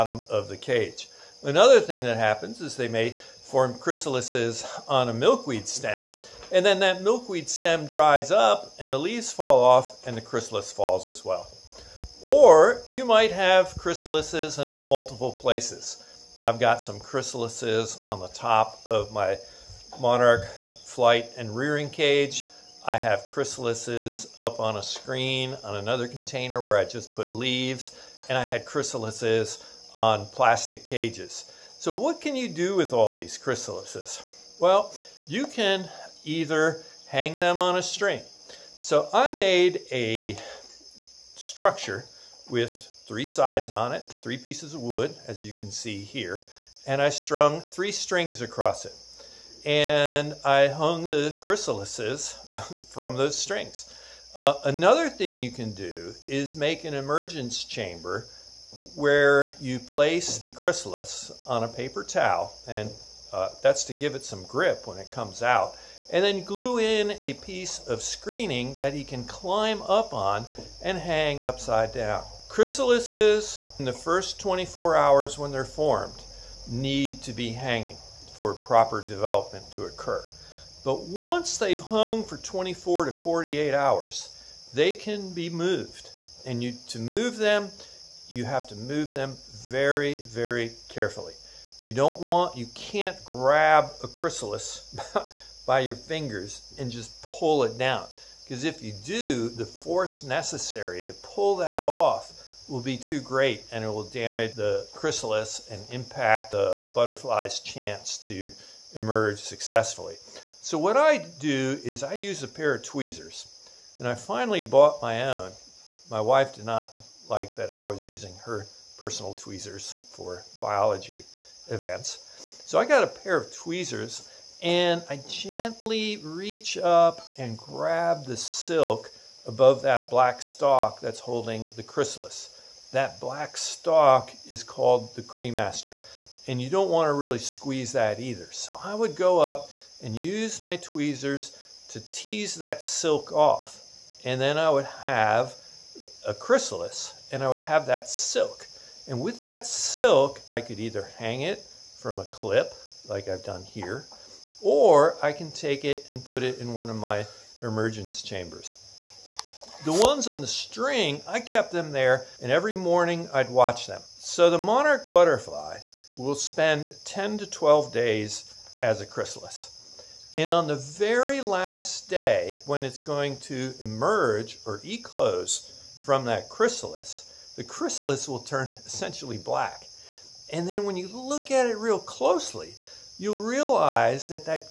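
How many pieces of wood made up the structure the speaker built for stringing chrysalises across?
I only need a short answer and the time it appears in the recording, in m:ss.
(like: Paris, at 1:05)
3, at 0:44.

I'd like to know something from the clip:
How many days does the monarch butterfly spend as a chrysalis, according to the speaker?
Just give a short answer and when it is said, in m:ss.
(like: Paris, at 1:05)
10 to 12 days, at 2:47.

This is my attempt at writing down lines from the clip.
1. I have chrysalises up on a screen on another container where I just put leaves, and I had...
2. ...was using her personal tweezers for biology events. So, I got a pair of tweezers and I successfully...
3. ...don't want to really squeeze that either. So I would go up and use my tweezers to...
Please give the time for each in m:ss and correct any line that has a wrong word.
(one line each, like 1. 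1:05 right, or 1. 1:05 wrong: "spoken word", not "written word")
1. 0:22 right
2. 1:57 wrong: "gently", not "successfully"
3. 2:16 right.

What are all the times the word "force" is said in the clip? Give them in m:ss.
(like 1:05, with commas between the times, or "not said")
1:39.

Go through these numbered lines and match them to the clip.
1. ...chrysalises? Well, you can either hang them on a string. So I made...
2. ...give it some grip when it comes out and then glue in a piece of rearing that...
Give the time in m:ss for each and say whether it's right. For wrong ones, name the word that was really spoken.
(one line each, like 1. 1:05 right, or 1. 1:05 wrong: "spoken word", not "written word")
1. 0:33 right
2. 1:03 wrong: "screening", not "rearing".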